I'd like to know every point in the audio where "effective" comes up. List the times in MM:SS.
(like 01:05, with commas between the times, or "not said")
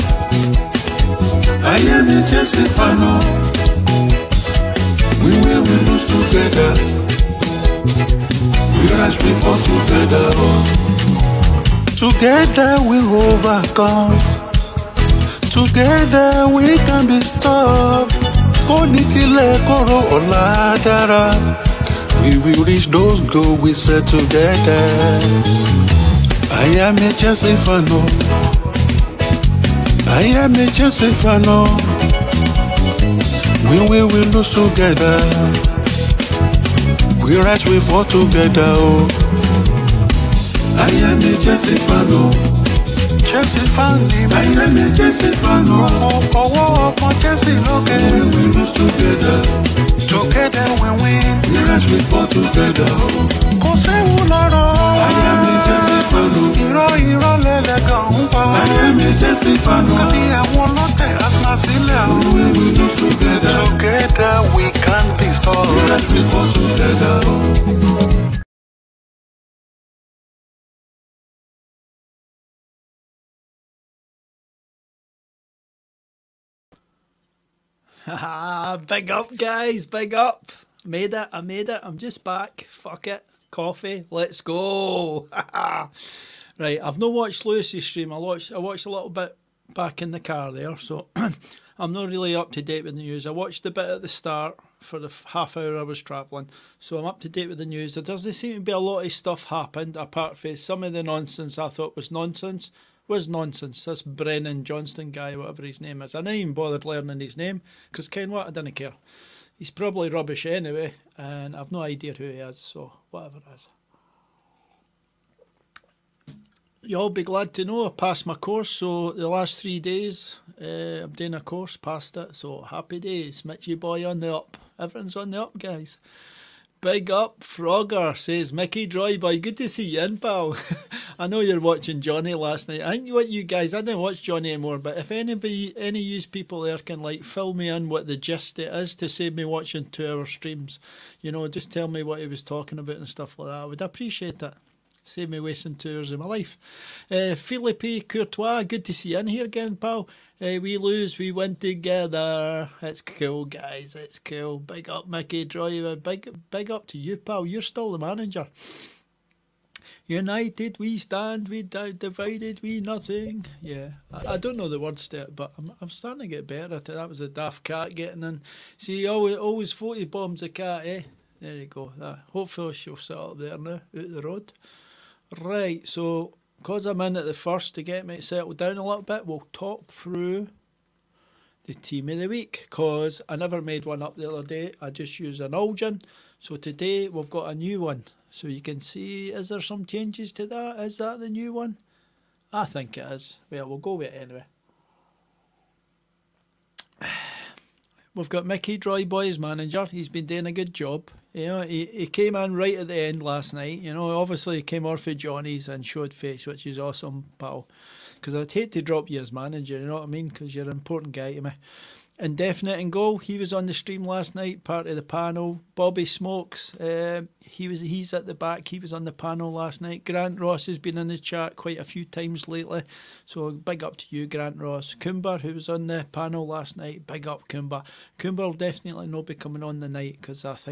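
not said.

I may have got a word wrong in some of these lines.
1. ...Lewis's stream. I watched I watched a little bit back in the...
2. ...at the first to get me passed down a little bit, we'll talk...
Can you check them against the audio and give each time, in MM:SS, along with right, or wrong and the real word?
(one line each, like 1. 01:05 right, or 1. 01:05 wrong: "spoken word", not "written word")
1. 01:27 right
2. 02:57 wrong: "settled", not "passed".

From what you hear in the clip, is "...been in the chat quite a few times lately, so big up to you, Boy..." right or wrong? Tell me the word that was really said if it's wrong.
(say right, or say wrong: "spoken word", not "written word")
wrong: "Grant", not "Boy".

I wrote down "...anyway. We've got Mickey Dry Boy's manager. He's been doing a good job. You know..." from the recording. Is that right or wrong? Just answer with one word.
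right.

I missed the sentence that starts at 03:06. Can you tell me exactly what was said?
So today we've got a new one.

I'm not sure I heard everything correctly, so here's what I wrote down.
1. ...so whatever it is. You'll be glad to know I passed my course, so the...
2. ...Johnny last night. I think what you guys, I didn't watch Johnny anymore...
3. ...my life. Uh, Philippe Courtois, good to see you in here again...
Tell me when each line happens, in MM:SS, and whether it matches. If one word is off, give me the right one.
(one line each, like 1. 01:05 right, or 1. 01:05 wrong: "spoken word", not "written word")
1. 01:52 right
2. 02:11 right
3. 02:26 right.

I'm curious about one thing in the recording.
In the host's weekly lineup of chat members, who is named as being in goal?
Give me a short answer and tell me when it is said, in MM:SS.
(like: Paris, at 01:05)
Indefinite, at 03:32.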